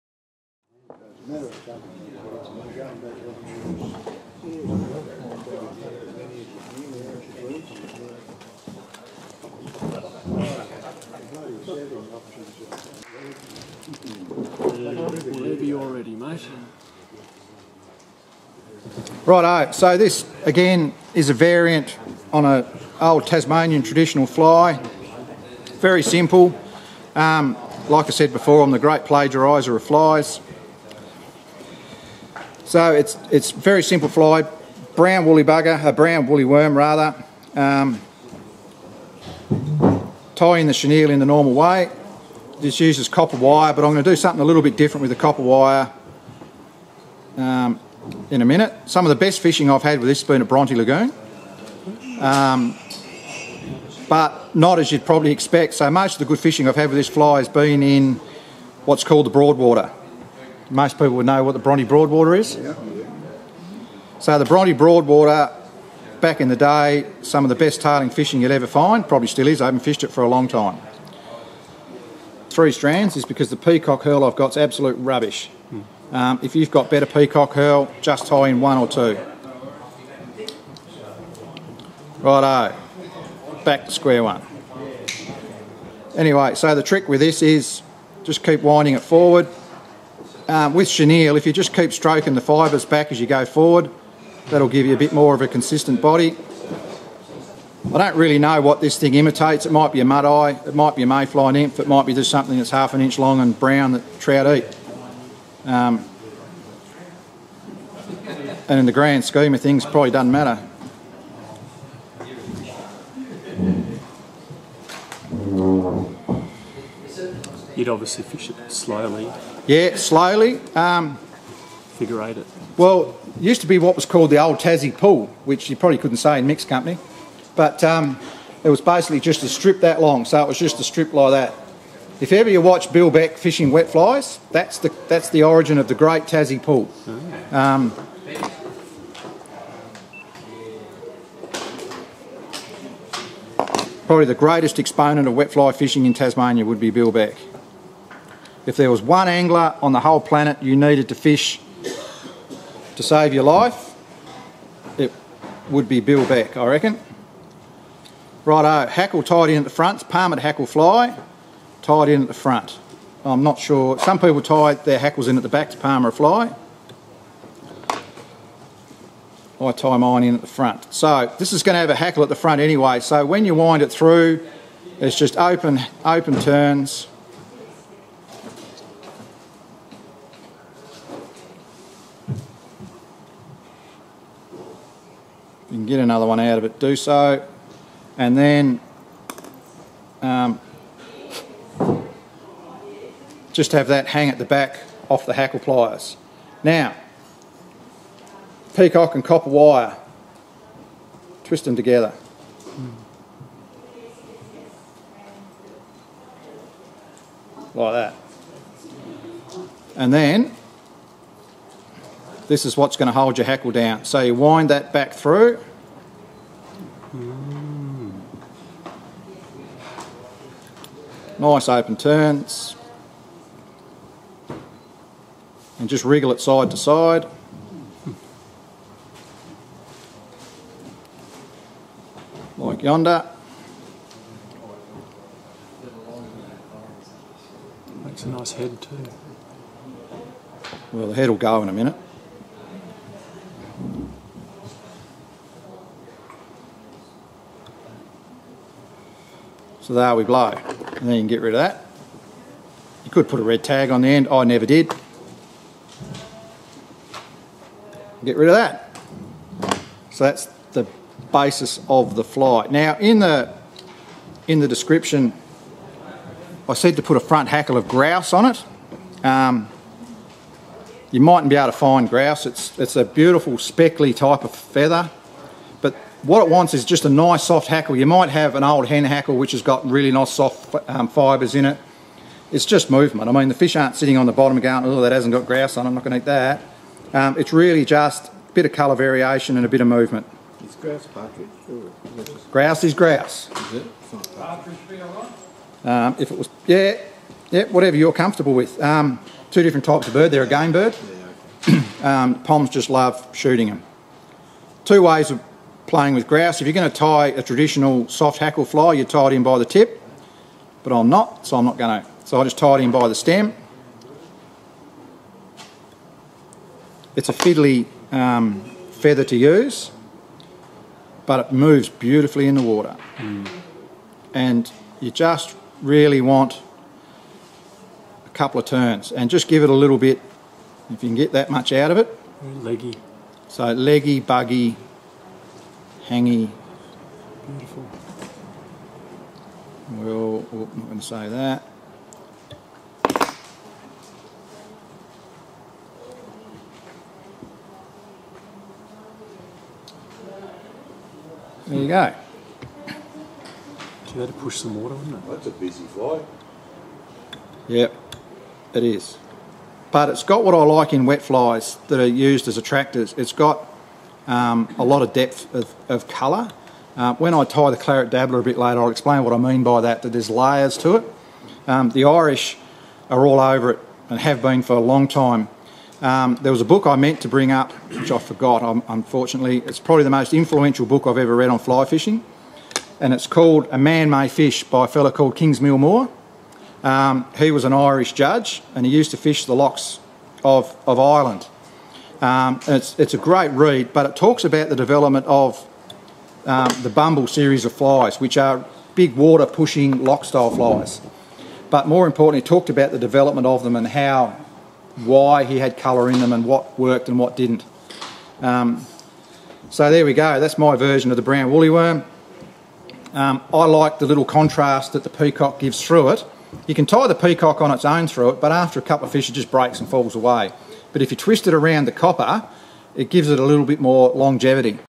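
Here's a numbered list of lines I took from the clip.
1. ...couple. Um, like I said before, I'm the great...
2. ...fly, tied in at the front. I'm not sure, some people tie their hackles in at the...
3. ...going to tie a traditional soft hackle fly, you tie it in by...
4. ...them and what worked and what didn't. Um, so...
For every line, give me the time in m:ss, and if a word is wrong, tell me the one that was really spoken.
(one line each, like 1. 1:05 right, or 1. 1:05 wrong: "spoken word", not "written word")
1. 0:26 wrong: "simple", not "couple"
2. 2:40 right
3. 5:06 right
4. 6:46 right.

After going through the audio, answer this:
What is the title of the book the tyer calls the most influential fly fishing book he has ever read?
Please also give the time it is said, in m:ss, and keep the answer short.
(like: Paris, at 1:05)
A Man May Fish, at 6:23.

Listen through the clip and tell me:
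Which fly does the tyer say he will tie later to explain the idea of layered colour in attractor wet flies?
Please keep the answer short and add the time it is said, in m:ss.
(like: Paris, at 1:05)
Claret dabbler, at 6:07.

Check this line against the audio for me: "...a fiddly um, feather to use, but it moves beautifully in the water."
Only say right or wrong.
right.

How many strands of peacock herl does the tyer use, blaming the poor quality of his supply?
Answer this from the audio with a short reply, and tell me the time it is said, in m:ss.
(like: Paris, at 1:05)
3, at 1:12.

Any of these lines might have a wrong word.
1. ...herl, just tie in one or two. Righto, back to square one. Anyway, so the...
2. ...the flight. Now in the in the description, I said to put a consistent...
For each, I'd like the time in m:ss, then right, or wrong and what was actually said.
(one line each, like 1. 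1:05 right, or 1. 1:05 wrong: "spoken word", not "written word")
1. 1:17 right
2. 4:22 wrong: "front", not "consistent".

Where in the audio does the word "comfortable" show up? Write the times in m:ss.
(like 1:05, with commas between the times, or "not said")
4:58.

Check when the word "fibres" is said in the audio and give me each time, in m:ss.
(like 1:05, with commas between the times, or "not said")
1:32, 4:41.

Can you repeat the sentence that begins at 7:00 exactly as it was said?
But if you twist it around the copper, it gives it a little bit more longevity.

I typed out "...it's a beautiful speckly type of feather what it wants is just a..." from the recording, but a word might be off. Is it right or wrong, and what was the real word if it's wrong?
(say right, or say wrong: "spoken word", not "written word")
right.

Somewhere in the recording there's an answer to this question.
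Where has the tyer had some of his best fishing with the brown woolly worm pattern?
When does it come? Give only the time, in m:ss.
0:50.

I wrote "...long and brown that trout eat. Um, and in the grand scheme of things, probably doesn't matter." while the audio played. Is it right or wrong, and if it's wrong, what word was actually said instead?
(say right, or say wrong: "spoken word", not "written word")
right.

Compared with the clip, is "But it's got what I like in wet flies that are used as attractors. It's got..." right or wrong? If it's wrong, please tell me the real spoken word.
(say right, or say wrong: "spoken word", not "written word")
right.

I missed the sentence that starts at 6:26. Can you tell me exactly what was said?
Um, he was an Irish judge, and he used to fish the loughs of, of Ireland.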